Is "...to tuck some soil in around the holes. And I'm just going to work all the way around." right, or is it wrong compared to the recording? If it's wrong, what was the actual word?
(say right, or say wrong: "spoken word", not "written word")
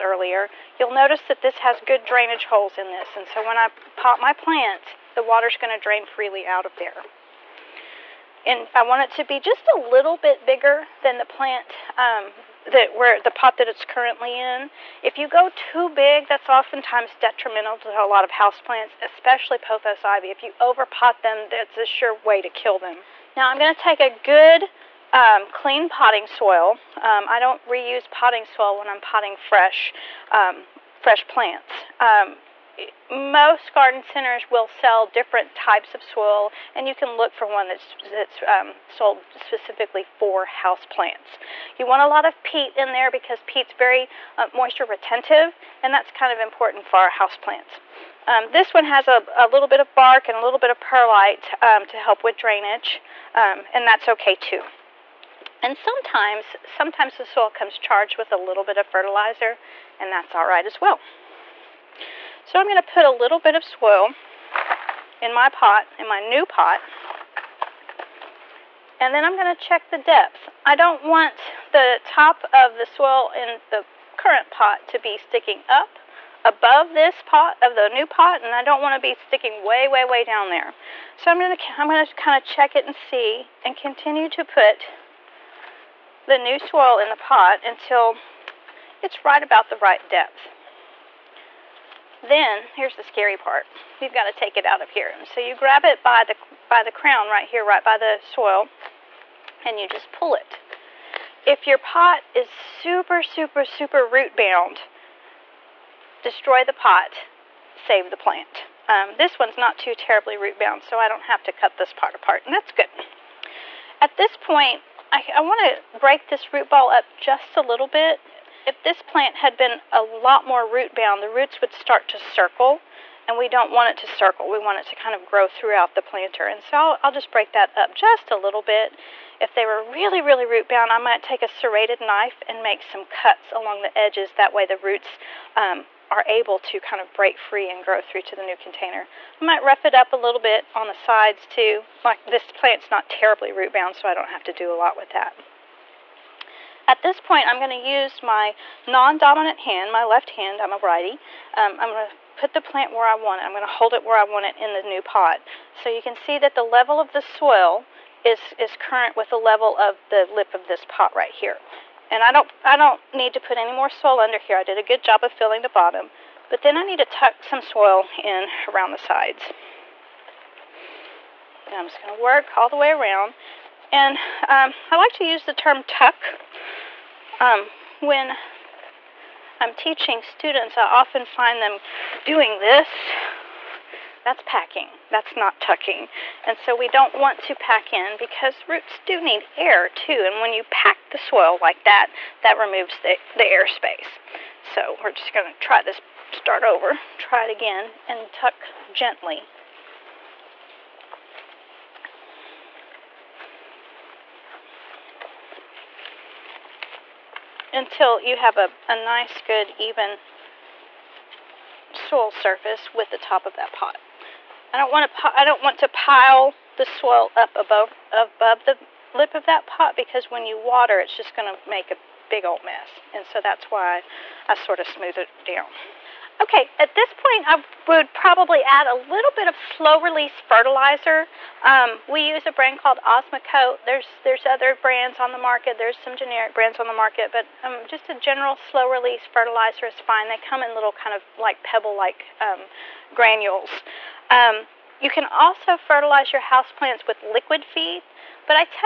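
wrong: "sides", not "holes".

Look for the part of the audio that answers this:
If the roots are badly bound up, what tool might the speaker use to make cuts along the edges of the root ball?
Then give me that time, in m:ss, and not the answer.
2:11.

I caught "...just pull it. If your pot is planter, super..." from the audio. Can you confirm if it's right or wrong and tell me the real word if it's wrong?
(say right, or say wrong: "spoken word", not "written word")
wrong: "super", not "planter".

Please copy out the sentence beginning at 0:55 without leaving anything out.
And sometimes, sometimes the soil comes charged with a little bit of fertilizer and that's alright as well.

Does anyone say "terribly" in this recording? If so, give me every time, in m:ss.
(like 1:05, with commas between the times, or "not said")
1:49, 2:23.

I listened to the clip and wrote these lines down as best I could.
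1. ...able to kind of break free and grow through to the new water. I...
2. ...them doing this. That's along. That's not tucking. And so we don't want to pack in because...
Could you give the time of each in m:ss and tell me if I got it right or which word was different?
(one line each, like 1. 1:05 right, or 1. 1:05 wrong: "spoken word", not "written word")
1. 2:16 wrong: "container", not "water"
2. 3:01 wrong: "packing", not "along".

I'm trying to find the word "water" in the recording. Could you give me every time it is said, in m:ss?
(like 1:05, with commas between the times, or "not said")
0:05, 3:40.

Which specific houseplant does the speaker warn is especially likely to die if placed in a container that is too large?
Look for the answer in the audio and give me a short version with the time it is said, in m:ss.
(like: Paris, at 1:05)
Pothos ivy, at 0:19.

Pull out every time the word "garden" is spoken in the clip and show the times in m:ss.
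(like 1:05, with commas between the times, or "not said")
0:33.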